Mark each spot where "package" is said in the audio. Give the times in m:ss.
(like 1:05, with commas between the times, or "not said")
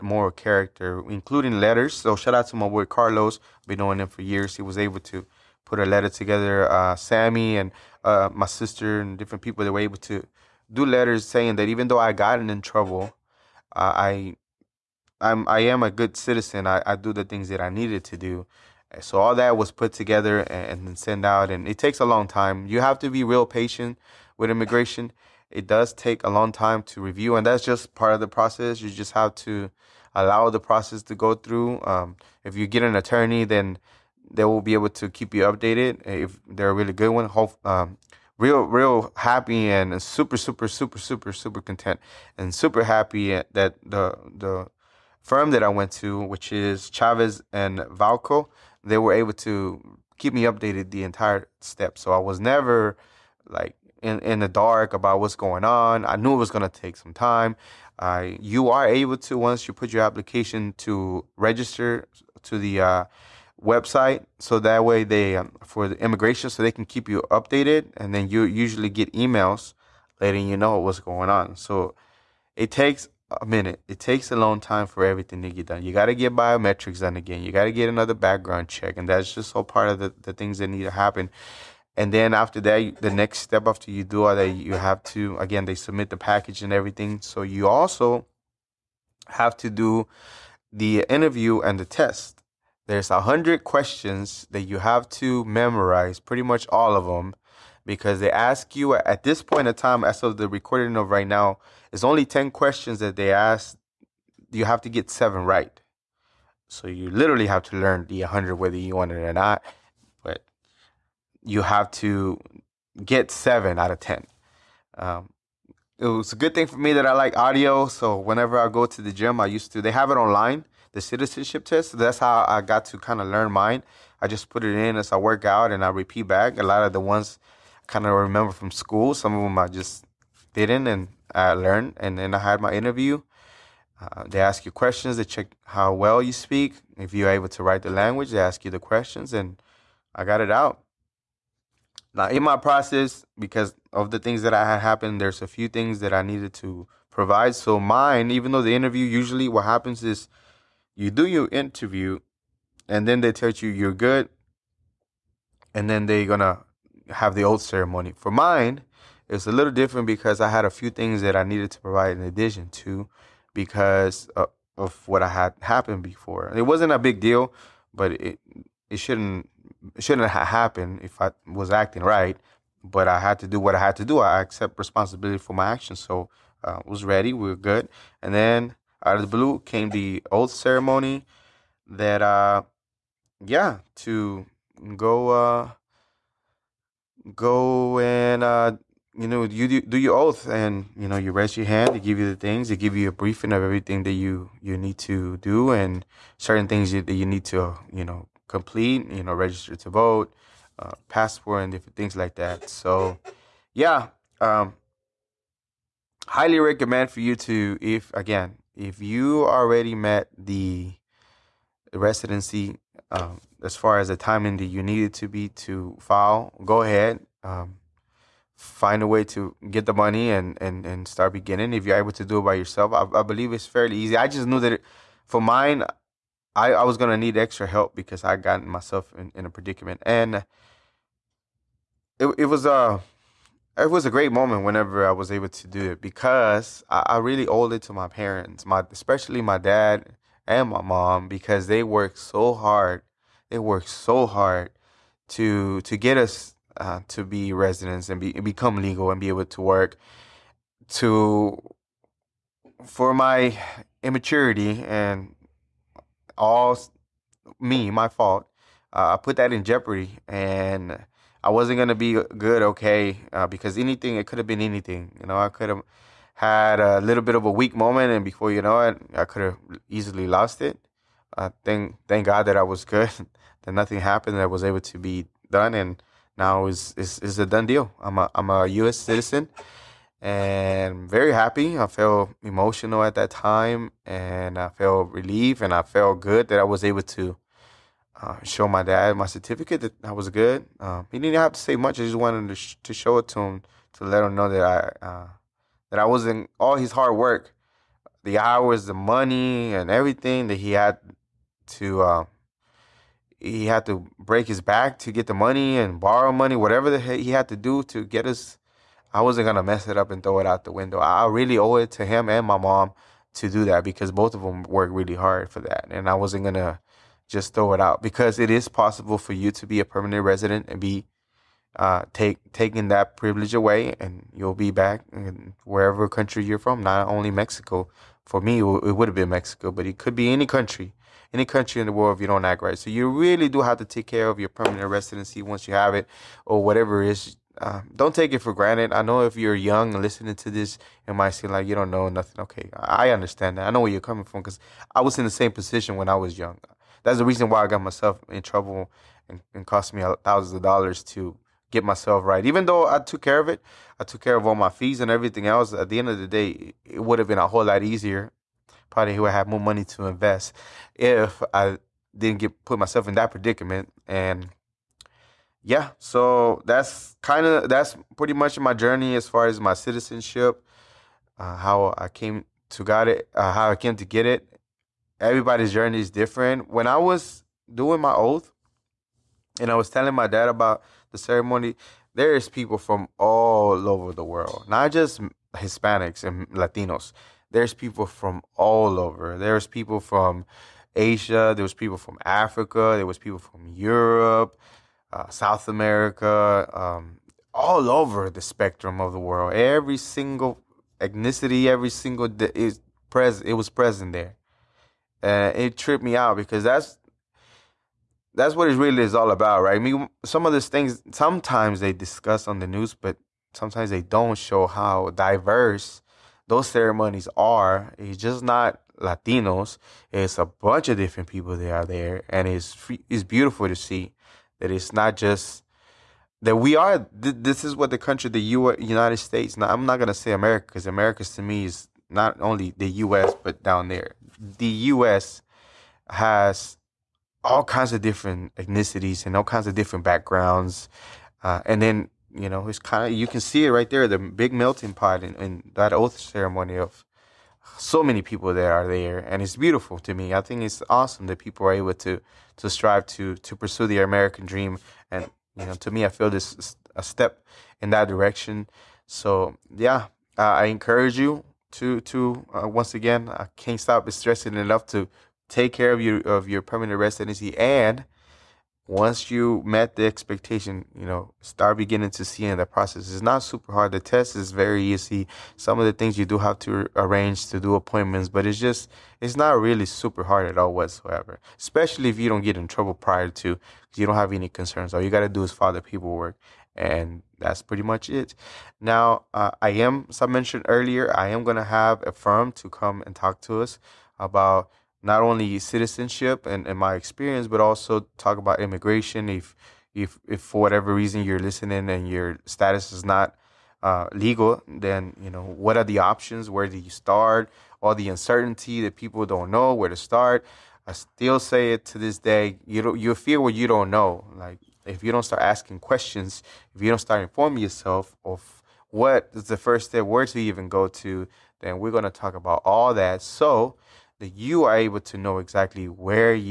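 1:26.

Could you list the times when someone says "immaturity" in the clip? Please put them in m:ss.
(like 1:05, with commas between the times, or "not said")
4:14.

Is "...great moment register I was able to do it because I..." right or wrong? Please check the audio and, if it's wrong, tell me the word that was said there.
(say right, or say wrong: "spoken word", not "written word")
wrong: "whenever", not "register".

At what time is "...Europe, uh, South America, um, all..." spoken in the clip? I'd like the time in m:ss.
6:33.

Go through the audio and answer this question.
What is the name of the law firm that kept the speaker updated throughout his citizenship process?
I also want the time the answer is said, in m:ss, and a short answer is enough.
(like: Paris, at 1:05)
Chavez and Valco, at 0:46.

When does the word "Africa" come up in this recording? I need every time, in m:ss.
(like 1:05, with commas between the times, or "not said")
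6:32.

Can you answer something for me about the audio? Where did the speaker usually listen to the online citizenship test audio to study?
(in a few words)
The gym.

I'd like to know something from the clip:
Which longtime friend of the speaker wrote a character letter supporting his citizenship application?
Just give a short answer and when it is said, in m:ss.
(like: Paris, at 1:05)
Carlos, at 0:02.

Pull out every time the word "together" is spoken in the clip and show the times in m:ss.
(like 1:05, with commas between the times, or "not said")
0:06, 0:19.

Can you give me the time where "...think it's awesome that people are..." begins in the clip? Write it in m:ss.
7:30.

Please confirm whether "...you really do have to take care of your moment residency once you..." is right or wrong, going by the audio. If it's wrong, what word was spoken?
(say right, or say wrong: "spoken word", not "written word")
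wrong: "permanent", not "moment".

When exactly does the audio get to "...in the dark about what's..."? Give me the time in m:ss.
0:54.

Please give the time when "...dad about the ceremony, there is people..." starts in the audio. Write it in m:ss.
6:20.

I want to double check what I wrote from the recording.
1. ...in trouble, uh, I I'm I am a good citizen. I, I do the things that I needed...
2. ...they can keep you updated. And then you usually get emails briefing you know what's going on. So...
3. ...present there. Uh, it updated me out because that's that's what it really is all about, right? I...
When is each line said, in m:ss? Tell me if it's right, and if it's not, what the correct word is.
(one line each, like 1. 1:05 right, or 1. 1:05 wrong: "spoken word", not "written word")
1. 0:12 right
2. 1:06 wrong: "letting", not "briefing"
3. 6:43 wrong: "tripped", not "updated".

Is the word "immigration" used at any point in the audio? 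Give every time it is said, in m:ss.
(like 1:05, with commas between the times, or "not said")
0:24, 1:05, 8:18.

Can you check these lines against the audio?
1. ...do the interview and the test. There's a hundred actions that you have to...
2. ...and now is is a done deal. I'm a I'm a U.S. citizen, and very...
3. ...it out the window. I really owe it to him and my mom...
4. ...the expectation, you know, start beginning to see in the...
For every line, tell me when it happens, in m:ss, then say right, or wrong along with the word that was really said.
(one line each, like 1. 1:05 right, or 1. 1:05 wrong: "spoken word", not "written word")
1. 1:29 wrong: "questions", not "actions"
2. 4:35 right
3. 5:10 right
4. 7:49 right.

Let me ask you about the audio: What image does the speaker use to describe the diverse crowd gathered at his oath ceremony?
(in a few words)
Melting pot.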